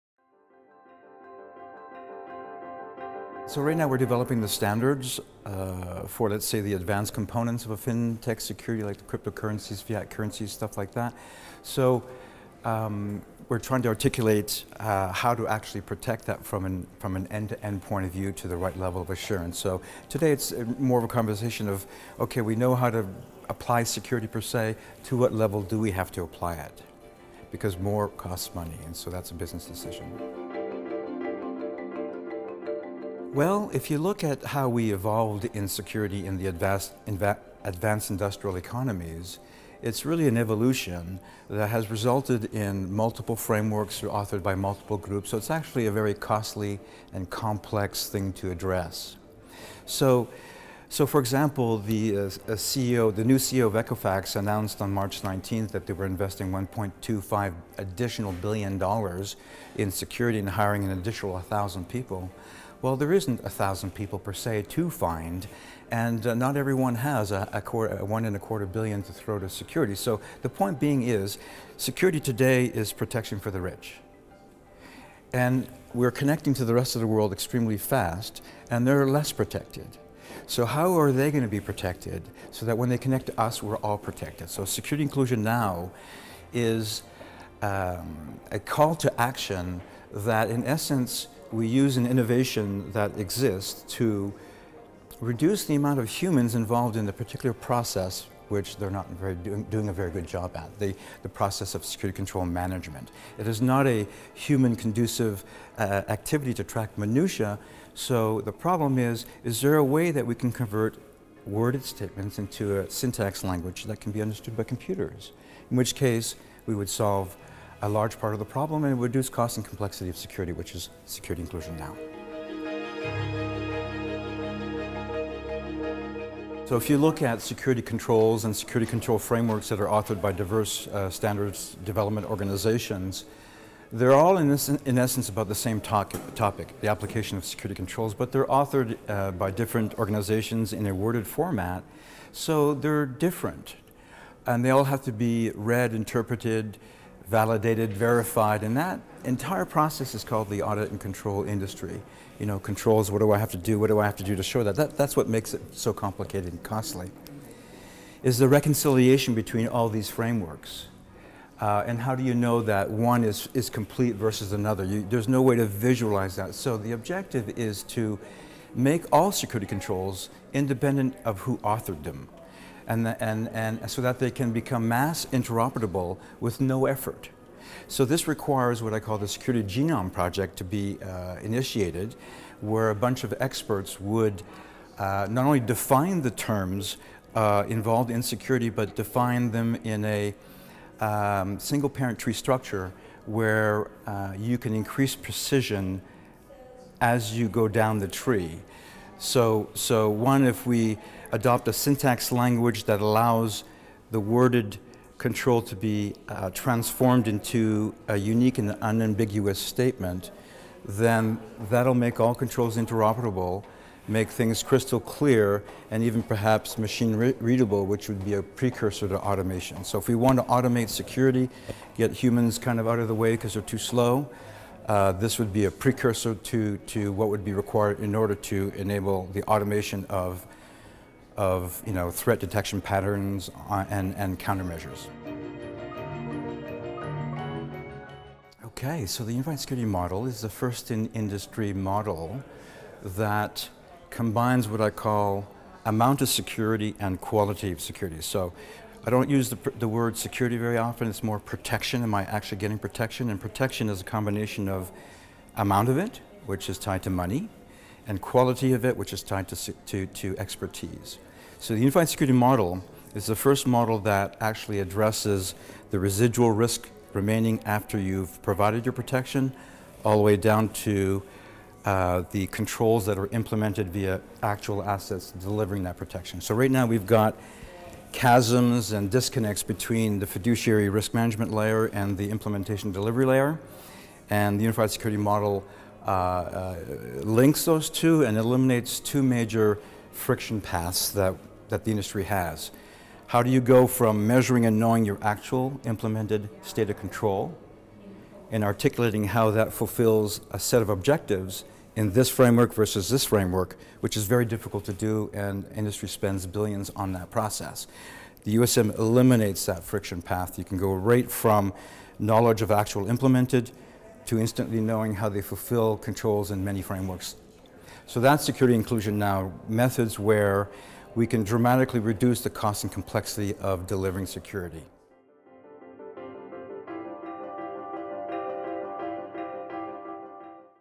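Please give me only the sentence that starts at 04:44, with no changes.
And the unified security model uh, uh, links those two and eliminates two major friction paths that, that the industry has.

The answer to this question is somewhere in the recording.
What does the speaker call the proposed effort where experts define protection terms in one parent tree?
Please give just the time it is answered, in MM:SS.
02:59.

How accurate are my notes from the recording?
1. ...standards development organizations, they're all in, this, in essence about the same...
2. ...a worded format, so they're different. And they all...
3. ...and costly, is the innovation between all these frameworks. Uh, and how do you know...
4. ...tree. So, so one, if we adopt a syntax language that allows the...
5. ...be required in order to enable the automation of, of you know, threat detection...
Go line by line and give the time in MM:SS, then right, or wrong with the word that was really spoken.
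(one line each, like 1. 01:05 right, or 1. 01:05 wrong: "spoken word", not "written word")
1. 02:11 right
2. 02:20 right
3. 02:36 wrong: "reconciliation", not "innovation"
4. 03:18 right
5. 03:47 right.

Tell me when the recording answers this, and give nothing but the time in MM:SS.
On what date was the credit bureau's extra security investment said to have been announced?
00:54.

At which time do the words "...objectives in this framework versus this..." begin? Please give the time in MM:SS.
05:00.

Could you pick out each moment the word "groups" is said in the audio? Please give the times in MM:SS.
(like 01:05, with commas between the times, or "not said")
00:44.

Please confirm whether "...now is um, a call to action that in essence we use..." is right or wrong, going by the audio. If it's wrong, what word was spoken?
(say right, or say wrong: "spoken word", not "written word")
right.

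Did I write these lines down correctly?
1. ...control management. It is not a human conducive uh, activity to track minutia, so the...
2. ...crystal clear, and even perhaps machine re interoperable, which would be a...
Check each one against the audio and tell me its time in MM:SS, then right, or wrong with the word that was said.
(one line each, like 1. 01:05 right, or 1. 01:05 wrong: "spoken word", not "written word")
1. 01:42 right
2. 03:34 wrong: "readable", not "interoperable".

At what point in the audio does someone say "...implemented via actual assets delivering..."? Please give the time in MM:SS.
04:33.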